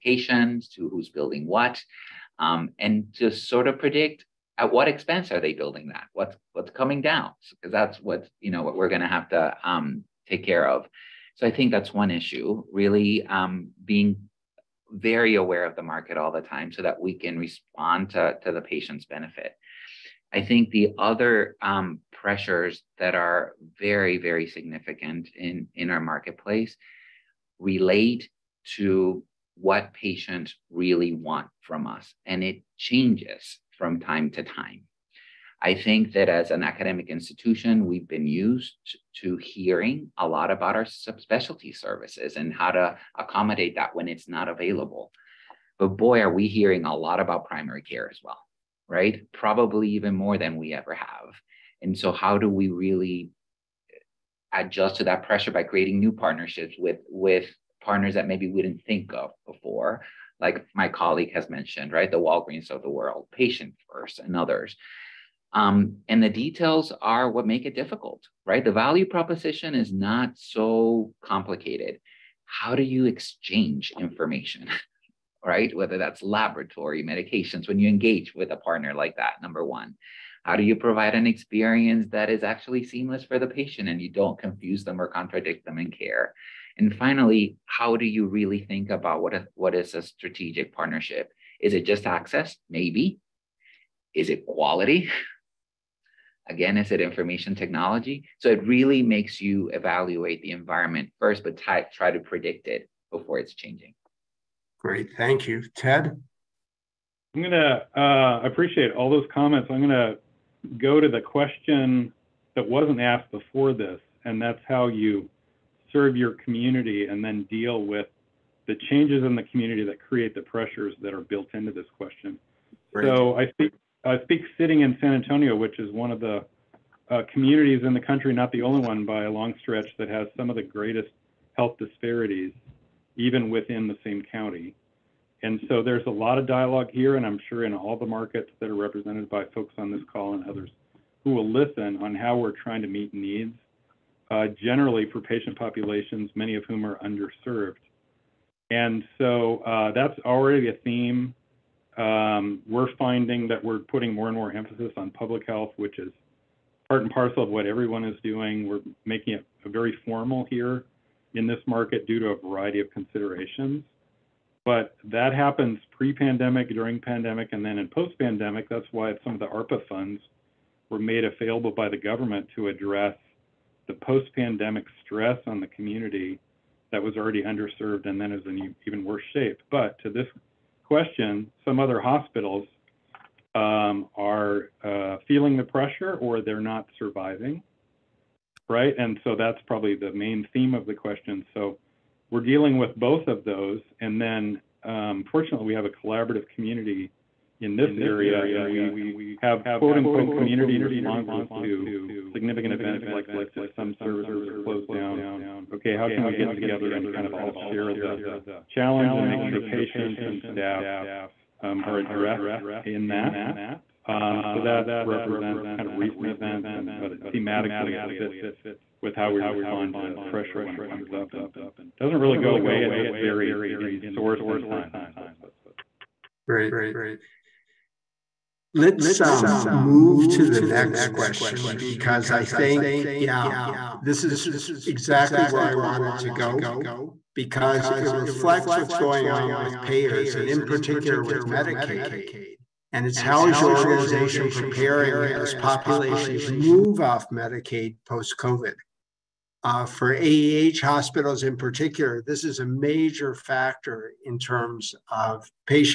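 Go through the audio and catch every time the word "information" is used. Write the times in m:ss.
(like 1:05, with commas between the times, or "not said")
1:13, 1:37.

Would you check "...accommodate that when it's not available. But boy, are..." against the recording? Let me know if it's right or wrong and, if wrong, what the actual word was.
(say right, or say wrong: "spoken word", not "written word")
right.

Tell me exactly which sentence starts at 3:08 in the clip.
And so that's probably the main theme of the question.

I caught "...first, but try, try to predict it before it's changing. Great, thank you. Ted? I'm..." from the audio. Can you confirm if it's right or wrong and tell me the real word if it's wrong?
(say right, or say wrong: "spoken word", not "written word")
right.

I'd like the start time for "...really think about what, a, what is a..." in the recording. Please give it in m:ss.
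1:28.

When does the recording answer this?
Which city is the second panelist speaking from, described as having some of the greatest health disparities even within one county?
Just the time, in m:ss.
2:04.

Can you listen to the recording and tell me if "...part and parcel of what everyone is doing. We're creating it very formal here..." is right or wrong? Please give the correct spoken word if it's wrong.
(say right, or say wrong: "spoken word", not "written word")
wrong: "making", not "creating".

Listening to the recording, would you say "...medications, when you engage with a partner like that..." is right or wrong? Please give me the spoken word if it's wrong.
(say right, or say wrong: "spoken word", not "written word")
right.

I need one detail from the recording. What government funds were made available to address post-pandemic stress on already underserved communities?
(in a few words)
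ARPA funds.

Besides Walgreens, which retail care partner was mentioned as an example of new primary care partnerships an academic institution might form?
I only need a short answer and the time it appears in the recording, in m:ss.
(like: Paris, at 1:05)
Patient First, at 1:03.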